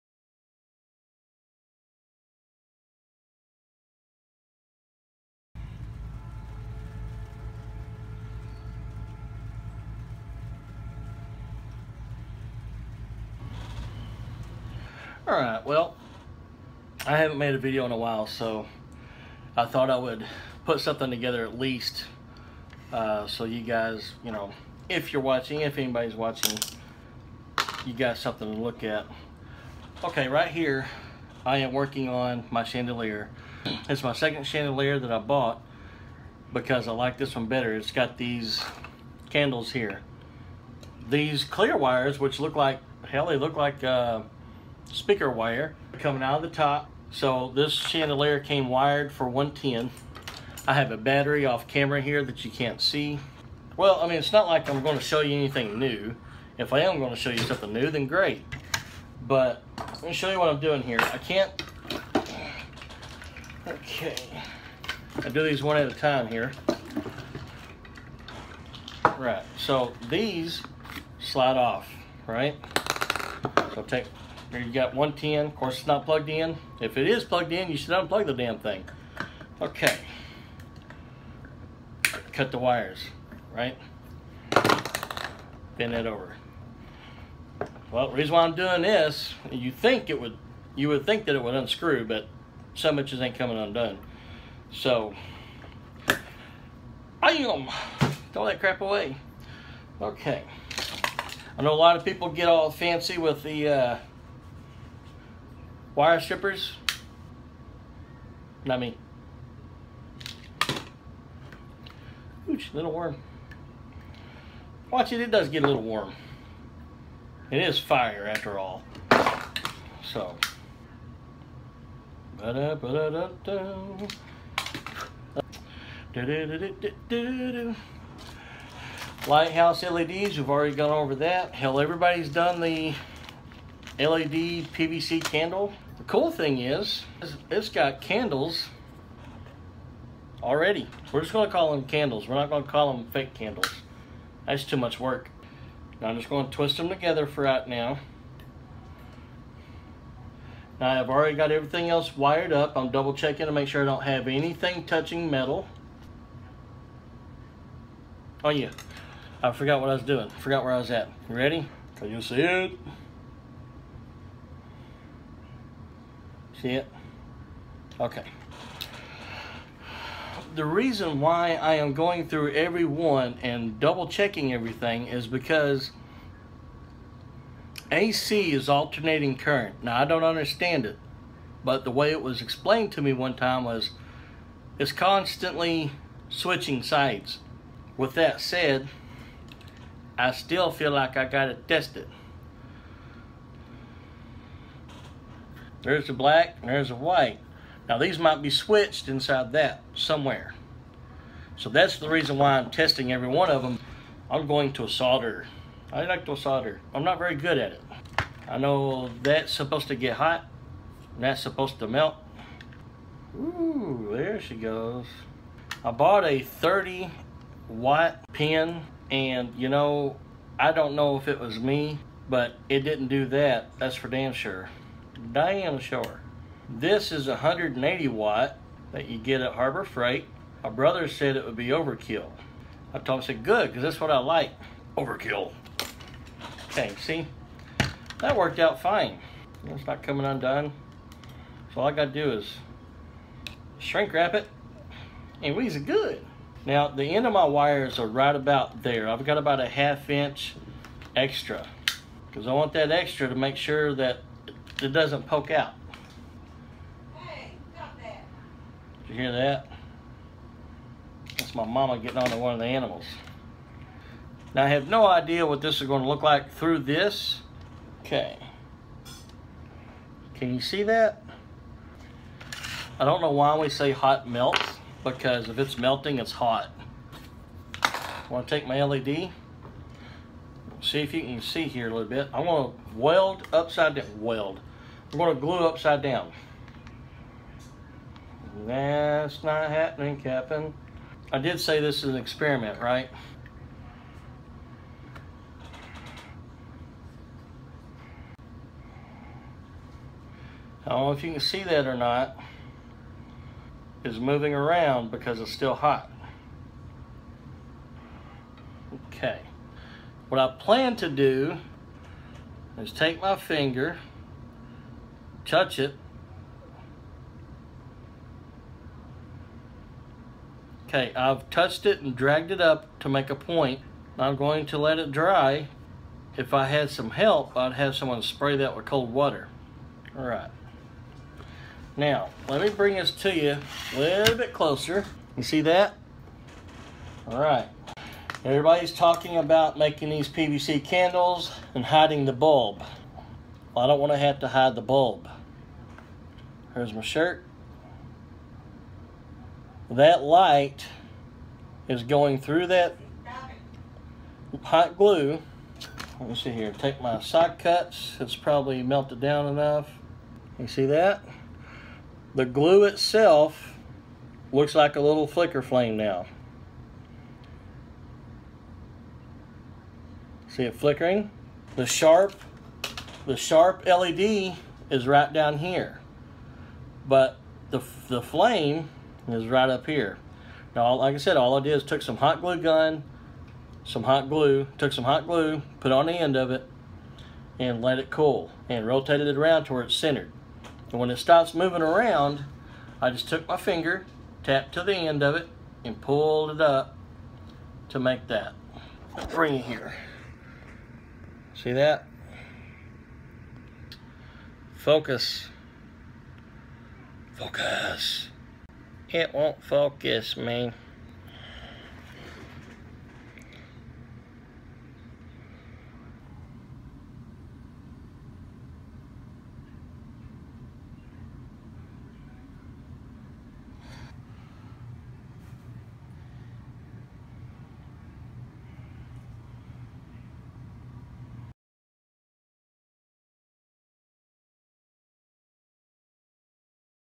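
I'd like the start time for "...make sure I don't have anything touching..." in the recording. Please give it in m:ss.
2:33.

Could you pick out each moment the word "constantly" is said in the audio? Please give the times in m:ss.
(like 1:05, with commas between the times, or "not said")
3:04.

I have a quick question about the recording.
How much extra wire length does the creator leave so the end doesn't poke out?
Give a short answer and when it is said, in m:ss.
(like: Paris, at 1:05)
half inch, at 4:09.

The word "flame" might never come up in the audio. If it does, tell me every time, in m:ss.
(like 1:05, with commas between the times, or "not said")
6:05, 6:18.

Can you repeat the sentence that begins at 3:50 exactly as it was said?
My brother said it would be overkill.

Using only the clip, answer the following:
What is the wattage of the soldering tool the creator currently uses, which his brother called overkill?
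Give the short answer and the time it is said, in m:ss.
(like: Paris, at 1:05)
180 watt, at 3:47.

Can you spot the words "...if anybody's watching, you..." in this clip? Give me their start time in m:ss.
0:25.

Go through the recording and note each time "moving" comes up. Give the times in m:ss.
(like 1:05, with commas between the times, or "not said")
5:04, 6:31.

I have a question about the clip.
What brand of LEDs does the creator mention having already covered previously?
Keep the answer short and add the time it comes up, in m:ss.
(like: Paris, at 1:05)
Lighthouse, at 2:09.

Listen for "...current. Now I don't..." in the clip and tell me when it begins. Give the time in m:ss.
2:59.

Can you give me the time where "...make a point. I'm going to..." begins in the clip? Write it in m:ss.
5:23.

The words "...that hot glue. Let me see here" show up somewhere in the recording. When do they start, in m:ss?
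5:52.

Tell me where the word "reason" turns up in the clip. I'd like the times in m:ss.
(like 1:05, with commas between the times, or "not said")
1:28, 2:50, 3:22.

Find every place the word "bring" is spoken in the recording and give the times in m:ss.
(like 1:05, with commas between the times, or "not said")
5:32, 6:39.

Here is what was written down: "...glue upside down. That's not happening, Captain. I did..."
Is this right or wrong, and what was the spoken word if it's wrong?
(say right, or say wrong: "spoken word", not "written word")
right.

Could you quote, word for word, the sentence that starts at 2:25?
Now I'm just gonna twist them together for right now.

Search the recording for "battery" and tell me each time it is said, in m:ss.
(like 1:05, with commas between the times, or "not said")
0:50.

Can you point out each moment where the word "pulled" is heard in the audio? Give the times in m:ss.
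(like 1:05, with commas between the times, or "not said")
6:36.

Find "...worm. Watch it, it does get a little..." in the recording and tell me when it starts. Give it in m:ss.
1:52.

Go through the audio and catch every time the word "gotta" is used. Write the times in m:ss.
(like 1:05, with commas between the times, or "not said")
3:11, 4:01.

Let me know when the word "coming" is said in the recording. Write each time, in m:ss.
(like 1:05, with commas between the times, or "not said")
0:45, 1:33, 4:00.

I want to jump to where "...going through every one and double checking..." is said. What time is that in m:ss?
2:51.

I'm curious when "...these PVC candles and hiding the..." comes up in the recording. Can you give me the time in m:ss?
5:40.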